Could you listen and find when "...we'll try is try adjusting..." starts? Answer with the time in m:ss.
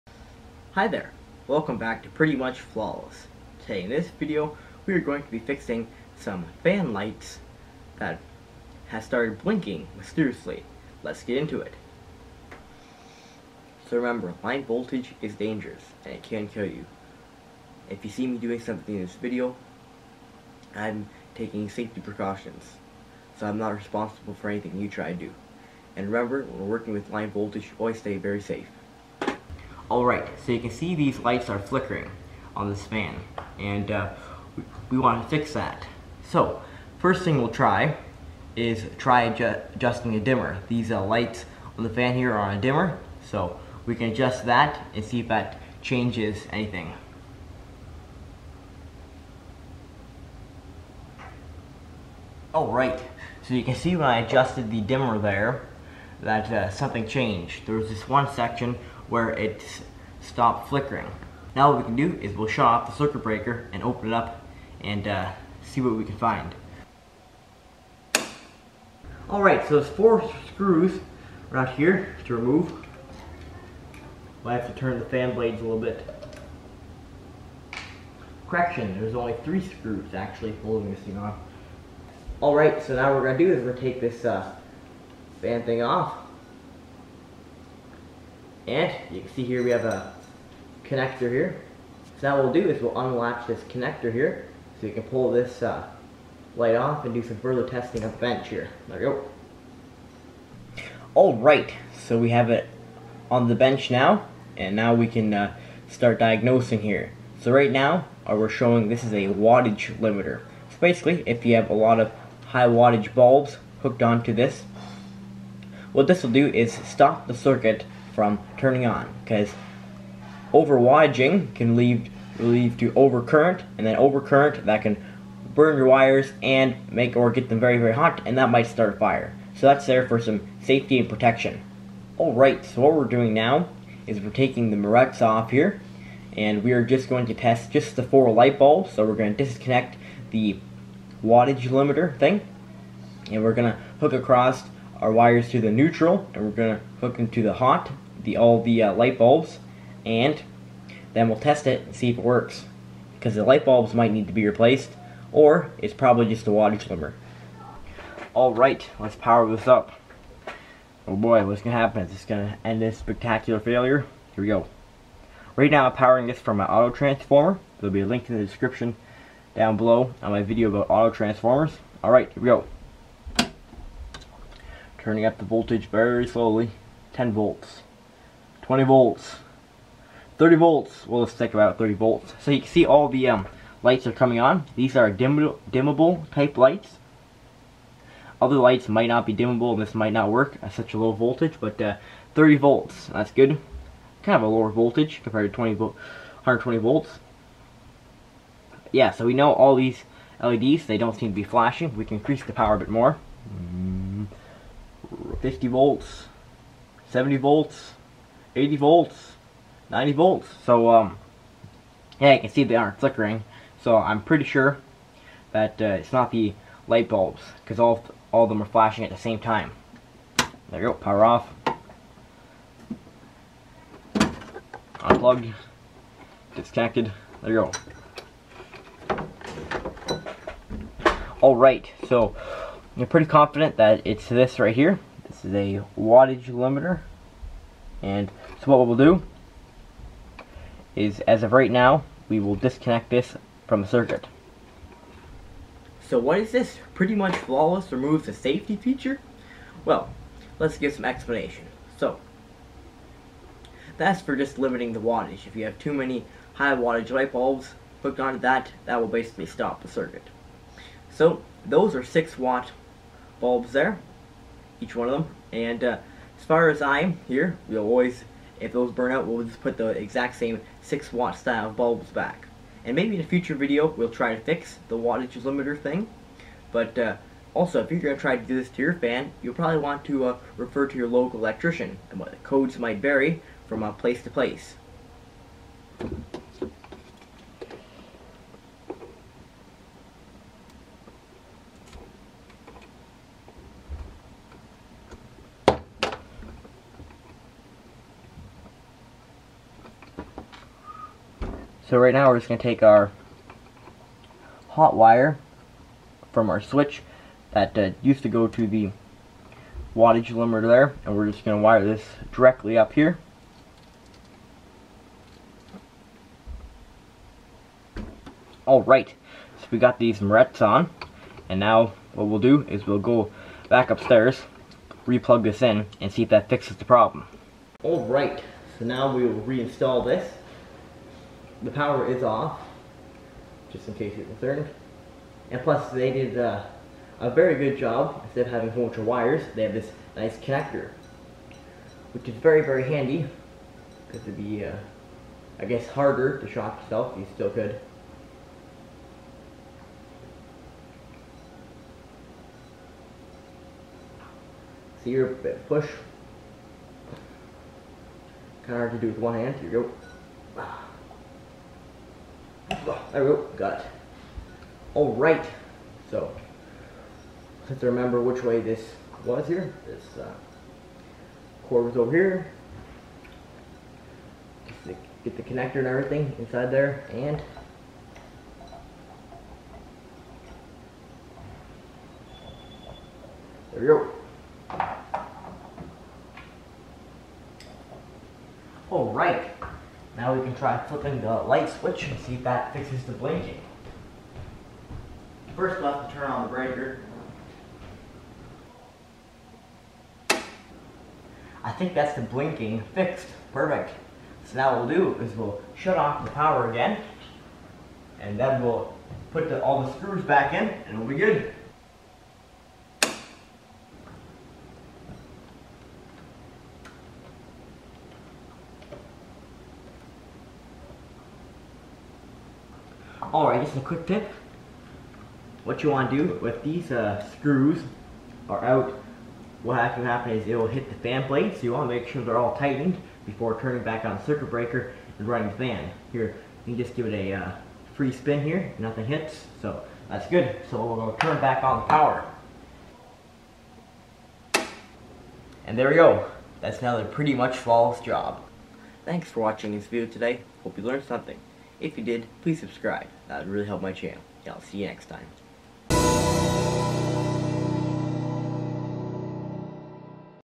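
0:37.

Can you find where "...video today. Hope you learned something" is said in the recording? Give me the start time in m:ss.
7:29.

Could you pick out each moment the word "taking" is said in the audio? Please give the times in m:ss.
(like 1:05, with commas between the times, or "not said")
0:21, 2:14.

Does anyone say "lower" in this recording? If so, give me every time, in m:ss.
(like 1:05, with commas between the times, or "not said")
3:14.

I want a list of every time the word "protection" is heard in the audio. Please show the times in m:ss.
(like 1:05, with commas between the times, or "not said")
2:11.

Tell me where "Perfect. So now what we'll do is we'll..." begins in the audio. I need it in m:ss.
6:43.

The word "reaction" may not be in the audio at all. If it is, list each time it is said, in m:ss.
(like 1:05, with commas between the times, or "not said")
not said.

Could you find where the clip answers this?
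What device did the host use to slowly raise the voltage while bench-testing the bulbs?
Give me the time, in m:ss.
2:46.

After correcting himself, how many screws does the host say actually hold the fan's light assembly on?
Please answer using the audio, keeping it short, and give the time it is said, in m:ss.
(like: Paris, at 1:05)
3, at 1:19.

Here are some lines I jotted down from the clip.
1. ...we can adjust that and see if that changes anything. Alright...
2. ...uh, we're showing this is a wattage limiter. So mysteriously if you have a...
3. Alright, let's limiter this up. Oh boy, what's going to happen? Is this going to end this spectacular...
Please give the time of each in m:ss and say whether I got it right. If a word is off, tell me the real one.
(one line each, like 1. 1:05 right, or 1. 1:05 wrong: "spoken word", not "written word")
1. 0:43 right
2. 1:48 wrong: "basically", not "mysteriously"
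3. 2:38 wrong: "power", not "limiter".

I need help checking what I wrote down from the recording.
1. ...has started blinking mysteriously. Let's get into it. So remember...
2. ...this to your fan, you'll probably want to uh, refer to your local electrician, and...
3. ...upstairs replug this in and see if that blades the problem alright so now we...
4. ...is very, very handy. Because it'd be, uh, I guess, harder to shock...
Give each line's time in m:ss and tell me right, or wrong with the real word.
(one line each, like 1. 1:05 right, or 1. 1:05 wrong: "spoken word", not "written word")
1. 0:08 right
2. 4:38 right
3. 5:23 wrong: "fixes", not "blades"
4. 5:42 right.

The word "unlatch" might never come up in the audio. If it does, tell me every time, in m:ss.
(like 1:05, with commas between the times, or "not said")
1:32.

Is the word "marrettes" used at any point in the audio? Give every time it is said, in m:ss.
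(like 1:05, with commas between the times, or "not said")
2:14, 5:20.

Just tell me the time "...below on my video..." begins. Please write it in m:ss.
2:49.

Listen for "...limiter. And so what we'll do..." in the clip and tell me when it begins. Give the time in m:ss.
3:56.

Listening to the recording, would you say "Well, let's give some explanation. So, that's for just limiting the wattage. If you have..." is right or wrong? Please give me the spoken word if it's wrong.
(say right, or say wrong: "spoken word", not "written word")
right.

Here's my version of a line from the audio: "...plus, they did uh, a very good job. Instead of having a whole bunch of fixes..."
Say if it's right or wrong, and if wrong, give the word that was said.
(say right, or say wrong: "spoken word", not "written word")
wrong: "wires", not "fixes".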